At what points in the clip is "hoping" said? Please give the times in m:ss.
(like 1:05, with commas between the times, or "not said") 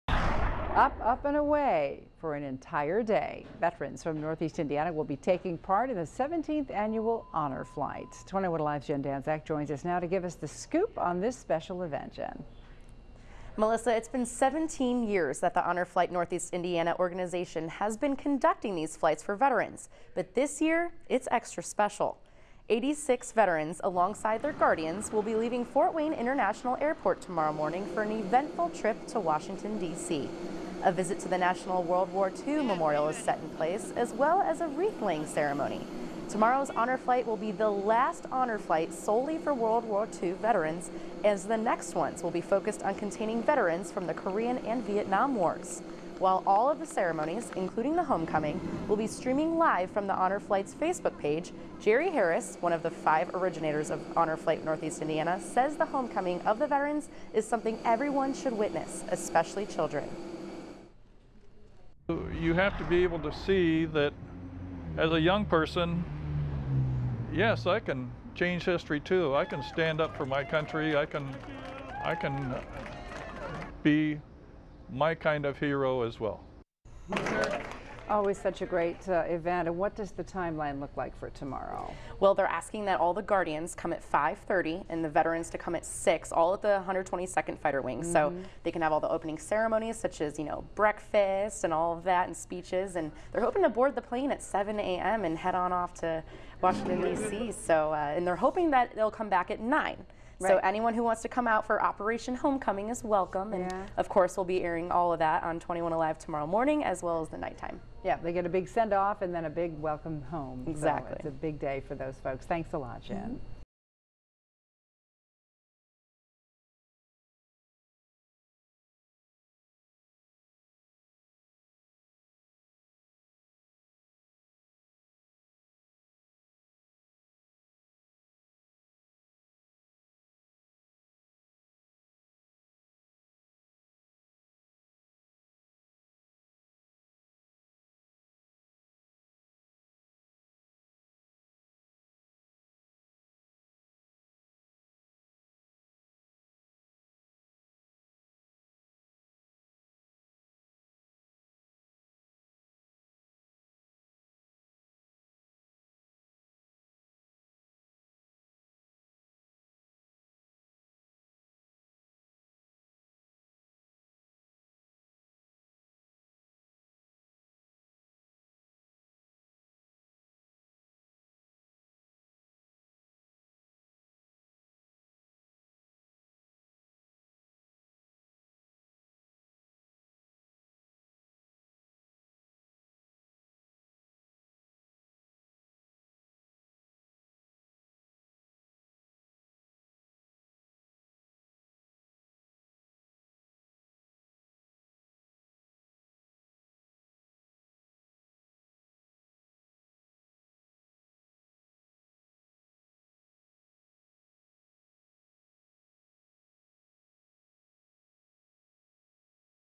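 1:33, 1:38.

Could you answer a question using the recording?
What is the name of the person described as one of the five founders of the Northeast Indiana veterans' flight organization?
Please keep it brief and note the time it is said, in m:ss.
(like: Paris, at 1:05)
Jerry Harris, at 0:51.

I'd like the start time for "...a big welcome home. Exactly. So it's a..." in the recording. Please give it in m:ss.
1:49.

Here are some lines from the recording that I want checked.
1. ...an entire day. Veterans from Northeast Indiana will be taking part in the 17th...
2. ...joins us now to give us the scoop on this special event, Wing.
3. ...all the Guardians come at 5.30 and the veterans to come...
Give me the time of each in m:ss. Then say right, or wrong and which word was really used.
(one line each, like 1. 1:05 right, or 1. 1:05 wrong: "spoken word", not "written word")
1. 0:02 right
2. 0:09 wrong: "Jen", not "Wing"
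3. 1:22 right.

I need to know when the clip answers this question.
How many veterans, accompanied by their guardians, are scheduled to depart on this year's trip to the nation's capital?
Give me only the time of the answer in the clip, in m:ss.
0:22.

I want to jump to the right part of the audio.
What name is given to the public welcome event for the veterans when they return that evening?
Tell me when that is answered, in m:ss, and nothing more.
1:41.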